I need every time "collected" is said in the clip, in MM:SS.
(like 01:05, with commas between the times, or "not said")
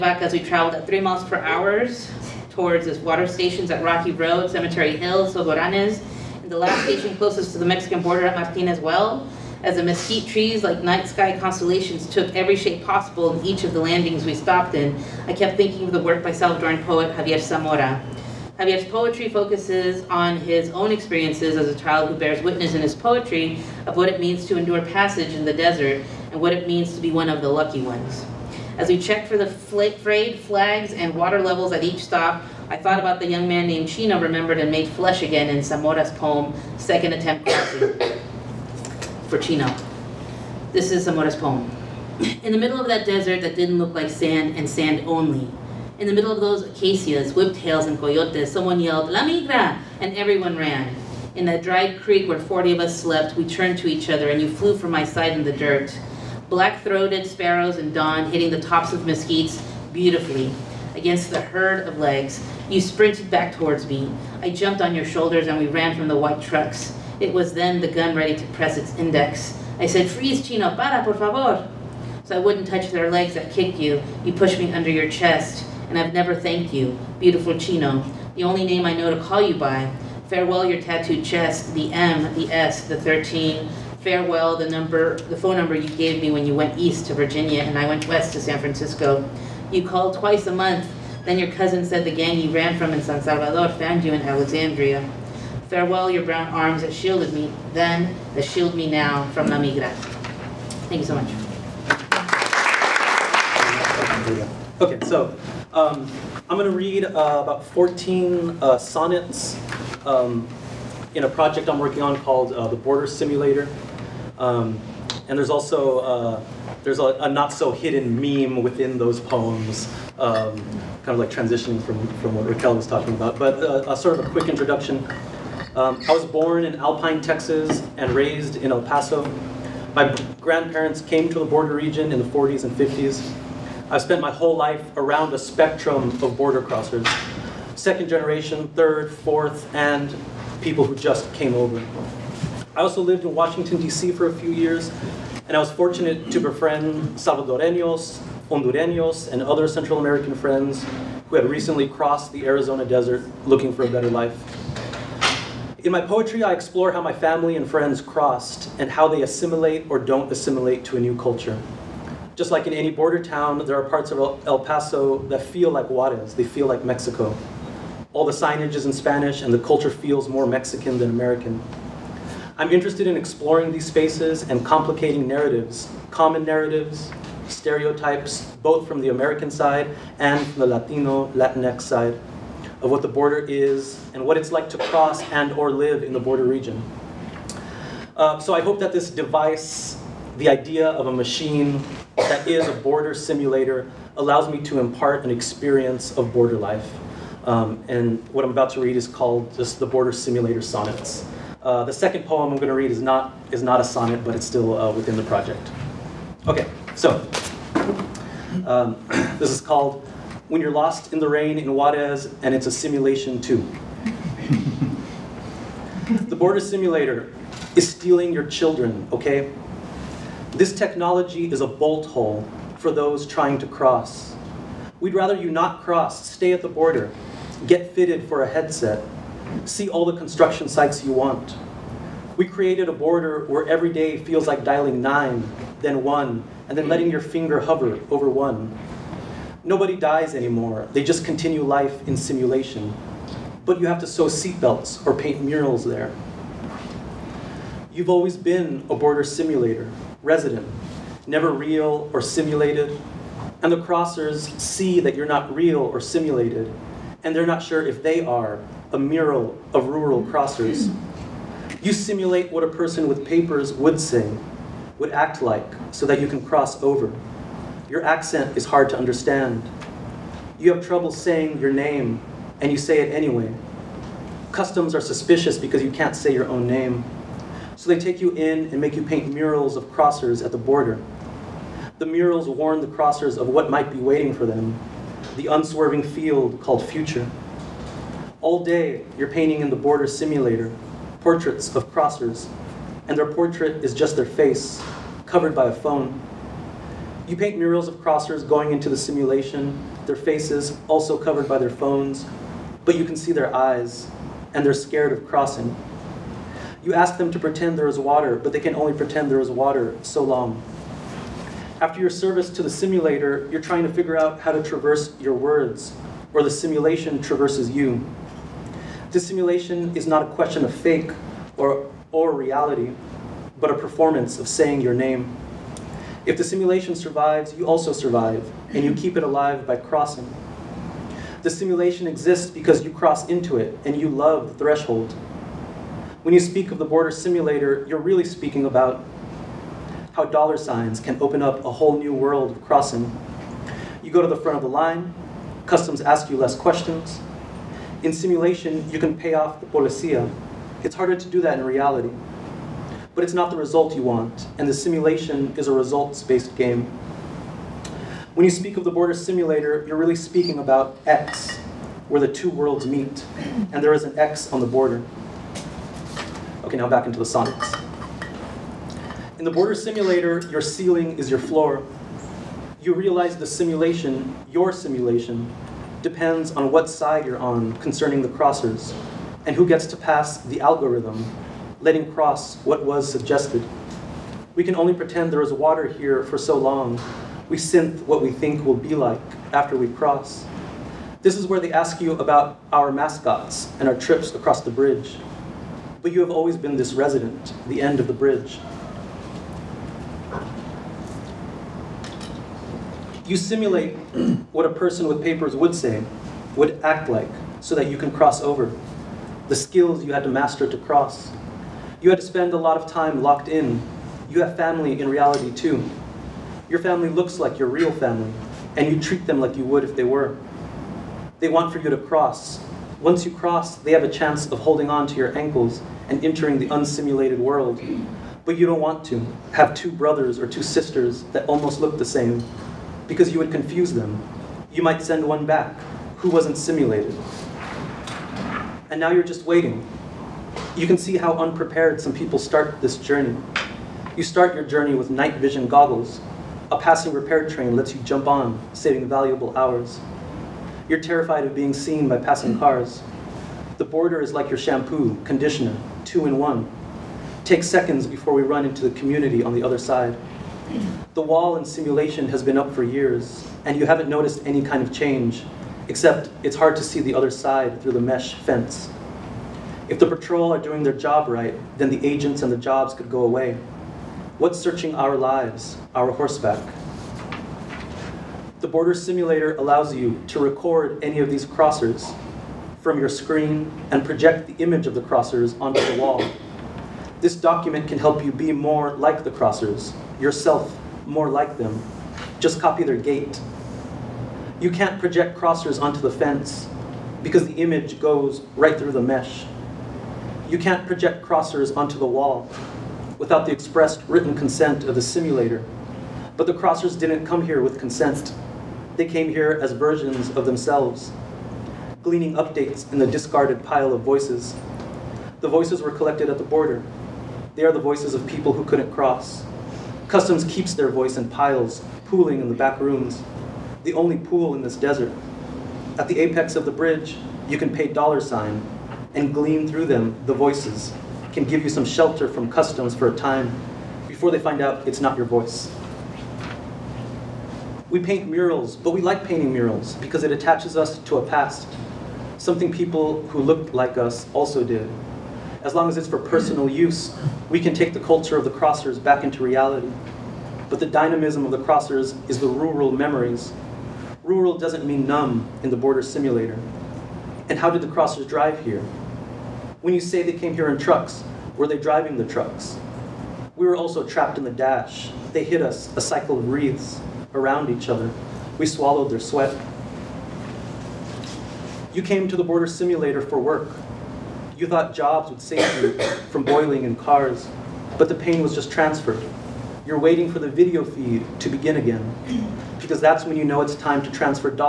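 08:35.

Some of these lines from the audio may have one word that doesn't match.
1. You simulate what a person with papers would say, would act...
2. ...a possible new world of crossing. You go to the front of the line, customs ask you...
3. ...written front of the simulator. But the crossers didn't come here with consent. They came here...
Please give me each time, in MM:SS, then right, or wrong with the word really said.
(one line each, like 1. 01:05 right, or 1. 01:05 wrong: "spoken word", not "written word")
1. 04:21 right
2. 05:41 wrong: "whole", not "possible"
3. 08:24 wrong: "consent", not "front".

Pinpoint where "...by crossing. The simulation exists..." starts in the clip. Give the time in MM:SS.
05:29.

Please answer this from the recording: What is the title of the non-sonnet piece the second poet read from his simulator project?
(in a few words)
When You're Lost in the Rain in Juarez.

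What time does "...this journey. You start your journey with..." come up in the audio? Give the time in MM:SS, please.
07:22.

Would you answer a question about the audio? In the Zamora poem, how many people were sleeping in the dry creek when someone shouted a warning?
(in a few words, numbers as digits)
40.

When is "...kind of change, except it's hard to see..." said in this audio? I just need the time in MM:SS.
07:44.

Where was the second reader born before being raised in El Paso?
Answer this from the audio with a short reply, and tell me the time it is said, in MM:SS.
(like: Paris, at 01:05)
Alpine, Texas, at 02:06.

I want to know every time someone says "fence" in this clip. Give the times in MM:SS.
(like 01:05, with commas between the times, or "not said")
07:48, 08:16.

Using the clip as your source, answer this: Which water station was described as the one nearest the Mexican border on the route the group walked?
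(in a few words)
Martinez Well.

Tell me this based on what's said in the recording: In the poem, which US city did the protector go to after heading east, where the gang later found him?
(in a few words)
Alexandria.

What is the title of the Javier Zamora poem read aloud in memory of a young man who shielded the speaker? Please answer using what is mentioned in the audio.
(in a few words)
Second Attempt.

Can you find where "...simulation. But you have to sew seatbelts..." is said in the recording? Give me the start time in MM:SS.
04:02.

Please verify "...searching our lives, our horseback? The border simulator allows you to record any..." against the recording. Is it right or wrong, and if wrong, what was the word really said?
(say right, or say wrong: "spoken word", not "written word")
right.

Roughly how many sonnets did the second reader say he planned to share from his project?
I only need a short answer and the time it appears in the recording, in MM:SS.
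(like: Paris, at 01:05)
14, at 01:47.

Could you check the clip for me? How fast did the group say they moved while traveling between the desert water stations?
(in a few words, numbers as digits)
3 miles per hour.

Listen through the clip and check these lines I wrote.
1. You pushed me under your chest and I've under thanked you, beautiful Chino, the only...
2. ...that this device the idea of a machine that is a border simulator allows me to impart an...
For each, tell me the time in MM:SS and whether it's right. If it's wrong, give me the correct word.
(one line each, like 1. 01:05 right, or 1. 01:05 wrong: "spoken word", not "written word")
1. 01:14 wrong: "never", not "under"
2. 03:08 right.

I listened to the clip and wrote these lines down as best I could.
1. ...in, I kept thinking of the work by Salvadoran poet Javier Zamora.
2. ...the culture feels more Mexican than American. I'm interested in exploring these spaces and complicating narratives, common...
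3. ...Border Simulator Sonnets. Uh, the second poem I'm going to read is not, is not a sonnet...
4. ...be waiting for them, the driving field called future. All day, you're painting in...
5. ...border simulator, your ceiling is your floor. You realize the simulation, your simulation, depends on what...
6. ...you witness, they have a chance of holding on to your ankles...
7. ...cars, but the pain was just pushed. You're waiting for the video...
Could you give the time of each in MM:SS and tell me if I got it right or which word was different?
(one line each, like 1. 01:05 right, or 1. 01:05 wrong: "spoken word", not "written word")
1. 00:14 right
2. 02:49 right
3. 03:19 right
4. 04:43 wrong: "unswerving", not "driving"
5. 06:09 right
6. 07:03 wrong: "cross", not "witness"
7. 09:36 wrong: "transferred", not "pushed".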